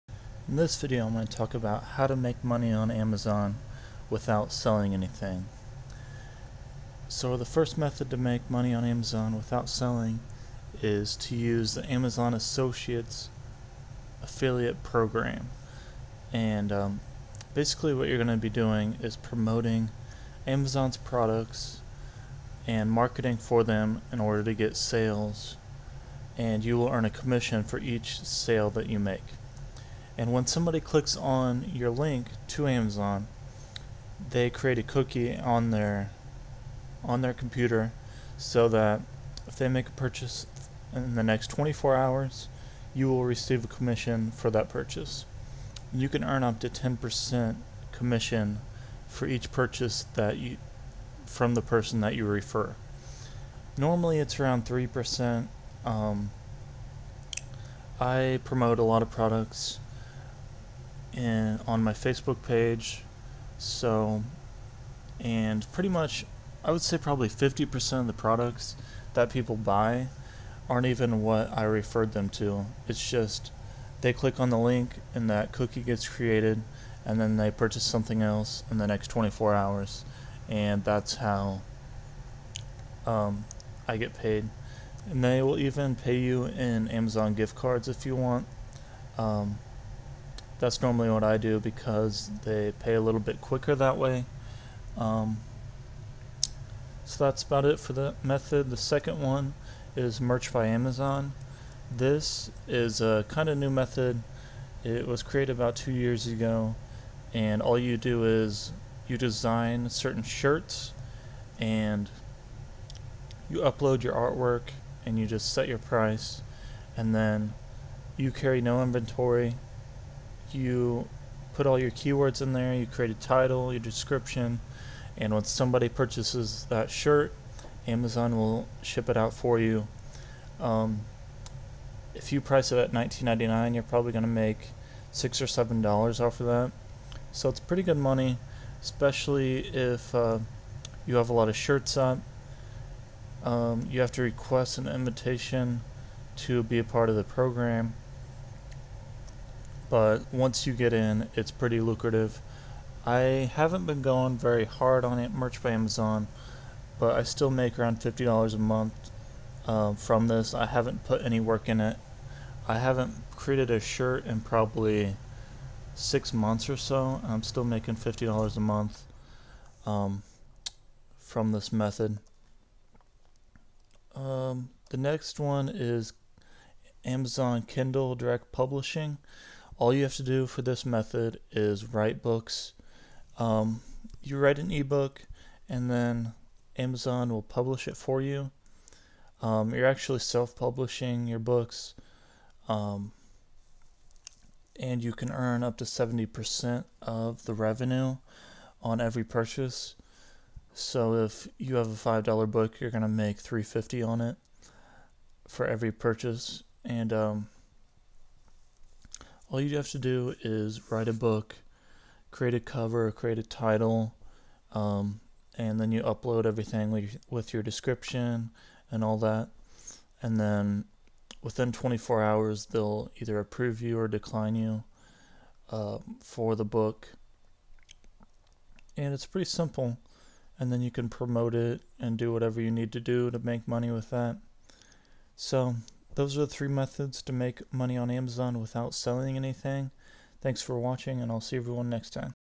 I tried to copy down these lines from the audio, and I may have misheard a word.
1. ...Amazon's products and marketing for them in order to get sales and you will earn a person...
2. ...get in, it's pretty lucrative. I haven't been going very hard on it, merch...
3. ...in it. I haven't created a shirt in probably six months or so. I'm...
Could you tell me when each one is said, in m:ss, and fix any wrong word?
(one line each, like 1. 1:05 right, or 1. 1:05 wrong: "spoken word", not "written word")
1. 0:20 wrong: "commission", not "person"
2. 2:30 right
3. 2:41 right.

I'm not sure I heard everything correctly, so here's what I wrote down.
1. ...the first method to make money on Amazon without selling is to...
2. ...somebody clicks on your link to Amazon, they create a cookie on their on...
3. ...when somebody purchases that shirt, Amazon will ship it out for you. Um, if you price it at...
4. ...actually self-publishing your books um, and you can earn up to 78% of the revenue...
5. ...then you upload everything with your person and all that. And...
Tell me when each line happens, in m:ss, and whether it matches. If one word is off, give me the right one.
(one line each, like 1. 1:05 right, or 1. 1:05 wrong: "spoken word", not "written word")
1. 0:07 right
2. 0:30 right
3. 2:05 right
4. 3:09 wrong: "70", not "78"
5. 3:35 wrong: "description", not "person".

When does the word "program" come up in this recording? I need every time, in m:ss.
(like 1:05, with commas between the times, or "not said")
0:14, 2:27.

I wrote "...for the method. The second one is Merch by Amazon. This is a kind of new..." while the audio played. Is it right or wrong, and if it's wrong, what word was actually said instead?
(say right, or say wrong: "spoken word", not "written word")
right.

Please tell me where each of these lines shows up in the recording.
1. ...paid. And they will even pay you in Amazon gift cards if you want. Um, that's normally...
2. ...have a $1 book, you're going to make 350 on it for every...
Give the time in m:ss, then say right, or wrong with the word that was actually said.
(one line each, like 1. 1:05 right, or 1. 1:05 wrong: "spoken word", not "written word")
1. 1:24 right
2. 3:21 wrong: "5", not "1".